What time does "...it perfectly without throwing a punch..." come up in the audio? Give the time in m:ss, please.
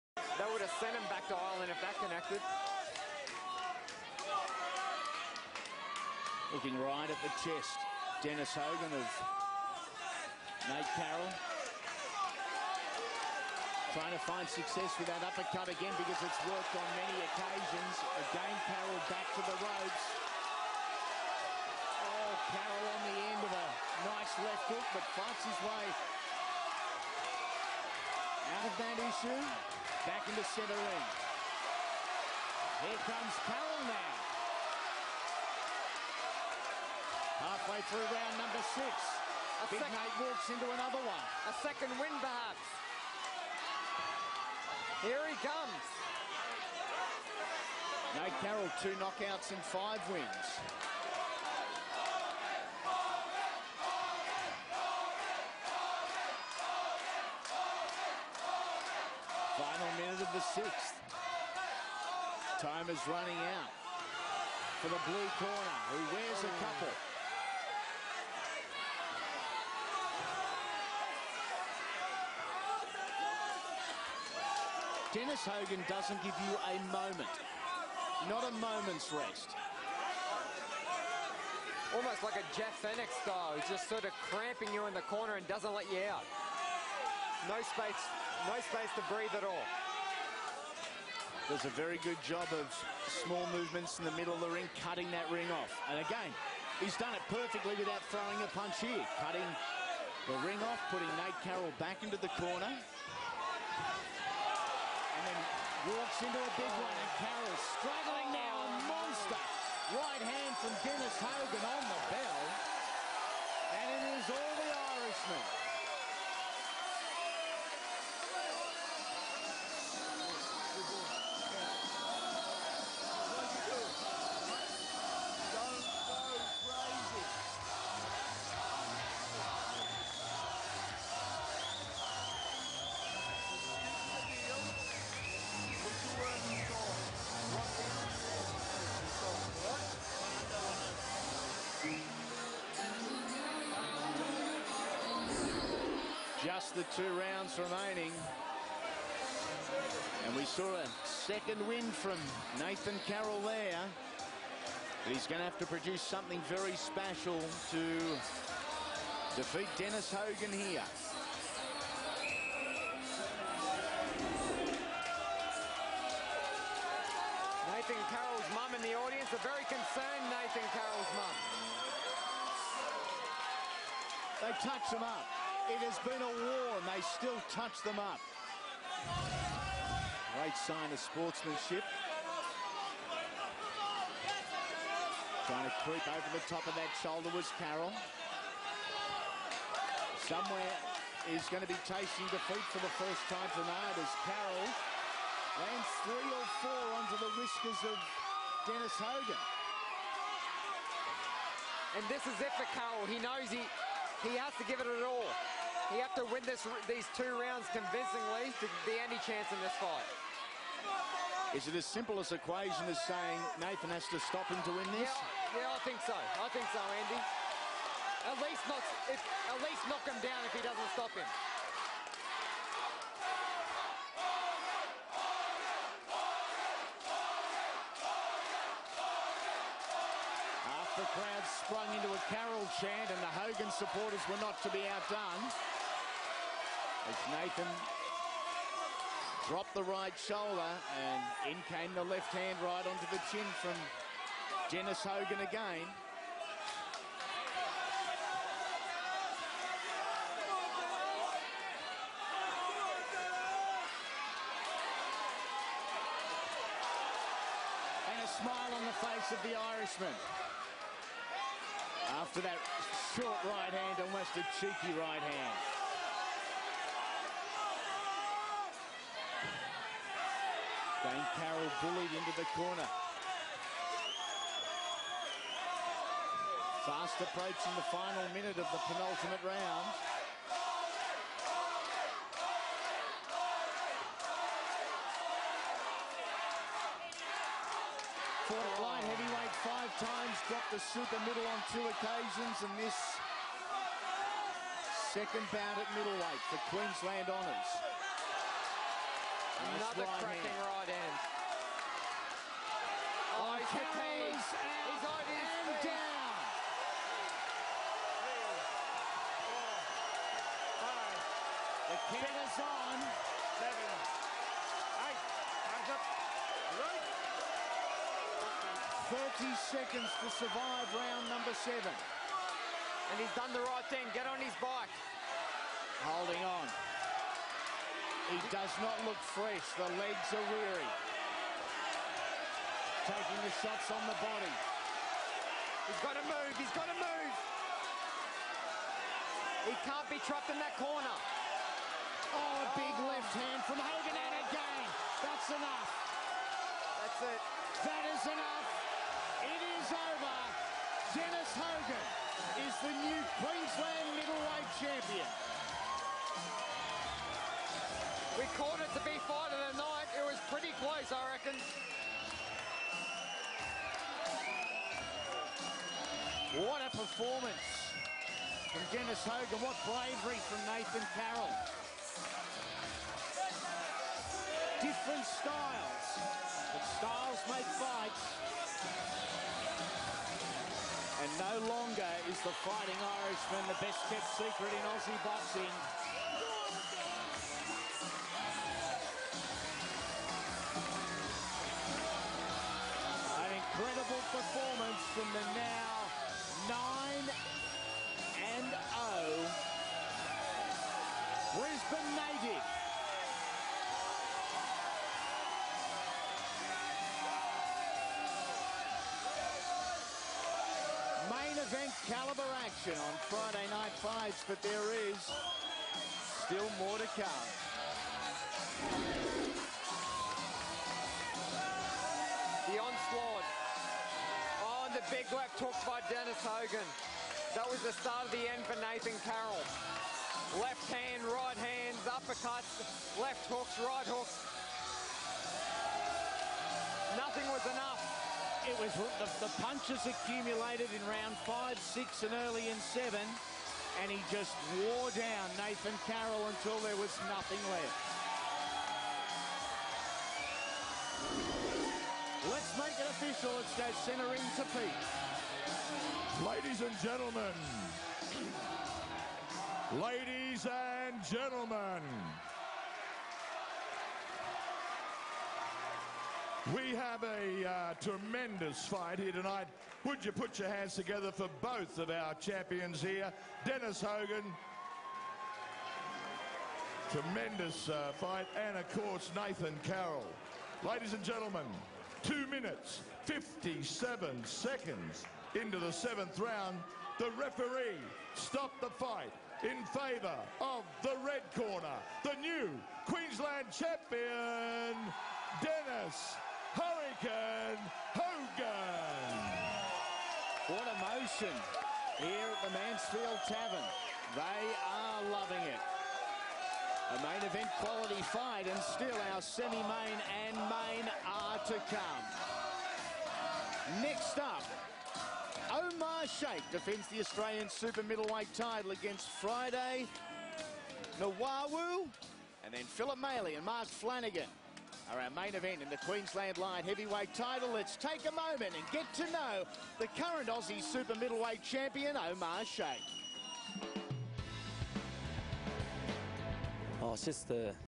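1:37.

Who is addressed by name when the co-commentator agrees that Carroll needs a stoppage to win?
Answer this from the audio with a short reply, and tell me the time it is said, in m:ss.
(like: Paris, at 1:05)
Andy, at 3:36.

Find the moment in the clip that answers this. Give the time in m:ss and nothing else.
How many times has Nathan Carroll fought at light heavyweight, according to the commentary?
4:49.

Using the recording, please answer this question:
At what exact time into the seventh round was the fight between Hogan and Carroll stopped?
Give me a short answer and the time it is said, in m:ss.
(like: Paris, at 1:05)
2 minutes 57 seconds, at 8:02.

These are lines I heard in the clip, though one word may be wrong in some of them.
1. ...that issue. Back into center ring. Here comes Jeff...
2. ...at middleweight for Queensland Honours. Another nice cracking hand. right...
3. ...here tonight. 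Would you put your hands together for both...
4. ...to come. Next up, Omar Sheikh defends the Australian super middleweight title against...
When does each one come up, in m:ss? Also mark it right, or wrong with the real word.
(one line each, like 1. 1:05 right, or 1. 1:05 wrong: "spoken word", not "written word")
1. 0:28 wrong: "Carroll", not "Jeff"
2. 4:55 right
3. 7:49 right
4. 8:31 right.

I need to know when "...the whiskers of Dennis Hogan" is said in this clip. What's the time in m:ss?
3:17.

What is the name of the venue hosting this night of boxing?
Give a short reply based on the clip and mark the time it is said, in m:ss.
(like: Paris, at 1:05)
Mansfield Tavern, at 8:22.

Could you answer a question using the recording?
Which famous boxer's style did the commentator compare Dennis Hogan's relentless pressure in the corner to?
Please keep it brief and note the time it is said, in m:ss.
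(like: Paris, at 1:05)
Jeff Fenech, at 1:22.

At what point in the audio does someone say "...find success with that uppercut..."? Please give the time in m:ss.
0:14.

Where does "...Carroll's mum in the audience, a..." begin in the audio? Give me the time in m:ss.
2:48.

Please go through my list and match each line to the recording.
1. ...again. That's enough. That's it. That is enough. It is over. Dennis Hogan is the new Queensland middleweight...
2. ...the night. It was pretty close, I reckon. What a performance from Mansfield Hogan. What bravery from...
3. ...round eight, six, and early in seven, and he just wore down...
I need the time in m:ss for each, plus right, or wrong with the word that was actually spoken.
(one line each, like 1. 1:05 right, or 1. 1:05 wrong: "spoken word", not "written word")
1. 5:44 right
2. 5:59 wrong: "Dennis", not "Mansfield"
3. 7:21 wrong: "five", not "eight".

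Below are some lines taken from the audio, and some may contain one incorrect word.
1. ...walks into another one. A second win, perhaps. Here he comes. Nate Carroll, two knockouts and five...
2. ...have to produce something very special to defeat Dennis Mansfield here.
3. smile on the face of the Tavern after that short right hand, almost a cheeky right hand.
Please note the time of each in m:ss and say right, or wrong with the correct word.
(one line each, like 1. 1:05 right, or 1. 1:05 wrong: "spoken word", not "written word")
1. 0:40 right
2. 2:35 wrong: "Hogan", not "Mansfield"
3. 4:18 wrong: "Irishman", not "Tavern".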